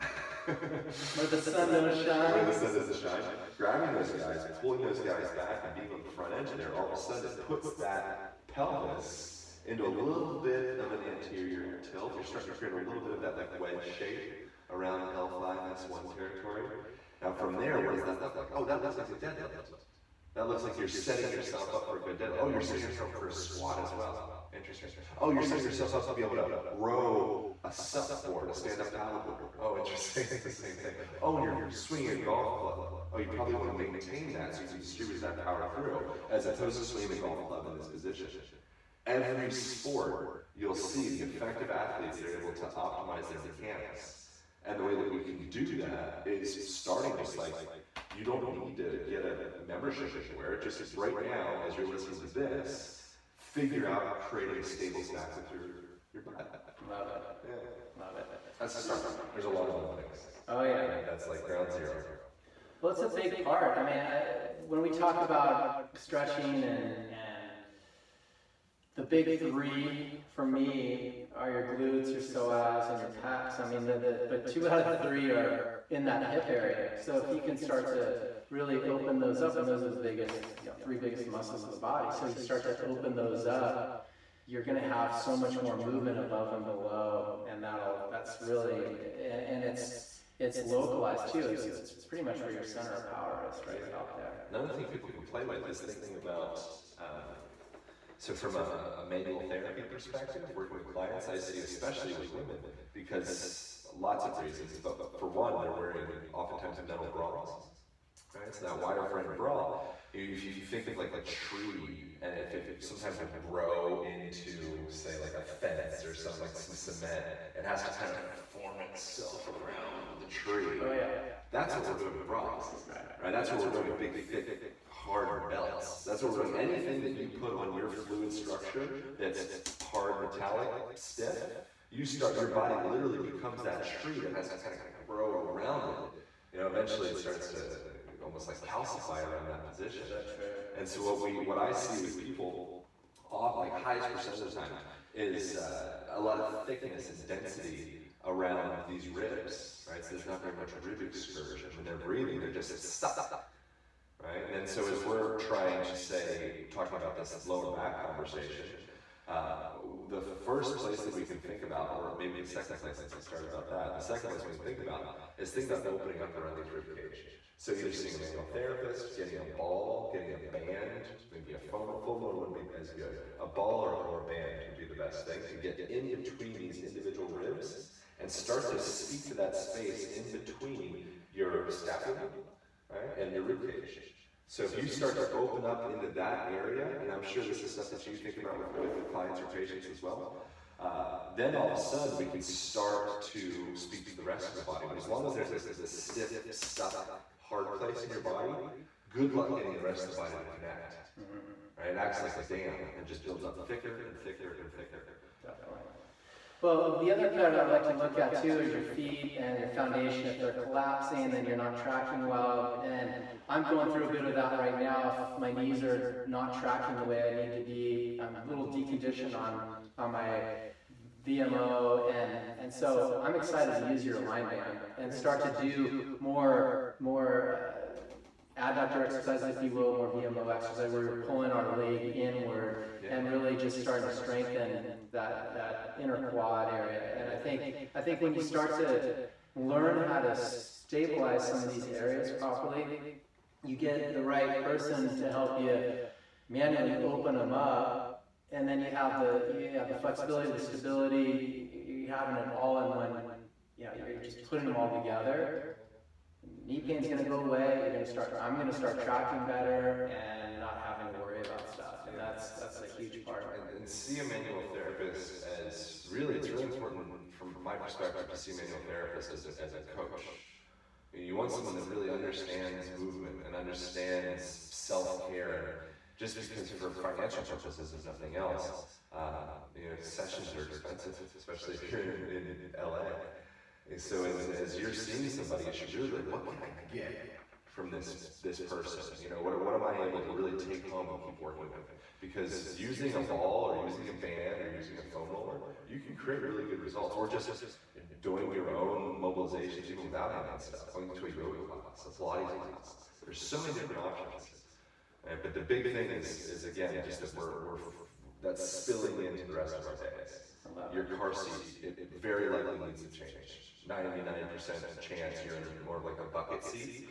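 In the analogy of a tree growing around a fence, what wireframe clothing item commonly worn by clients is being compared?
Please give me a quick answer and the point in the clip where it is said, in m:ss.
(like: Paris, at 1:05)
metal bras, at 1:46.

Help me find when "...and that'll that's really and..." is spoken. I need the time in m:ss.
1:27.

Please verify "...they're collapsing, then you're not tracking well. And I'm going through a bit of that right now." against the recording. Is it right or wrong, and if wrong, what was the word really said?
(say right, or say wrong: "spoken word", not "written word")
right.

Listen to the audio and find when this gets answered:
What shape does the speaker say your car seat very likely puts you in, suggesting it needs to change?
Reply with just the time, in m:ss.
5:16.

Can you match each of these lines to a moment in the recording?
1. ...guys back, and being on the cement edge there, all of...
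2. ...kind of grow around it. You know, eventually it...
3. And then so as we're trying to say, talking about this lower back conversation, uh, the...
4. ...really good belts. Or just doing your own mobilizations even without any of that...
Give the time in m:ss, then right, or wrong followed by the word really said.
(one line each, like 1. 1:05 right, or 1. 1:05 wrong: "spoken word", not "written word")
1. 0:04 wrong: "front", not "cement"
2. 2:14 right
3. 2:34 right
4. 4:56 wrong: "results", not "belts".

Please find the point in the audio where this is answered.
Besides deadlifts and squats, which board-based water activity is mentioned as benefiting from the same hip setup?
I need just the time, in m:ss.
0:28.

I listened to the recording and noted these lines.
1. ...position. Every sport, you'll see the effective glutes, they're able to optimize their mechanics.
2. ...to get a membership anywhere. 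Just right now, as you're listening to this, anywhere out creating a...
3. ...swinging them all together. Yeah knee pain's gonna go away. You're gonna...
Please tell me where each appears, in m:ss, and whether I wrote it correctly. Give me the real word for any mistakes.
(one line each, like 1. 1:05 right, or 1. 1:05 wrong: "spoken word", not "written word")
1. 0:37 wrong: "athletes", not "glutes"
2. 0:48 wrong: "figure", not "anywhere"
3. 4:14 wrong: "putting", not "swinging".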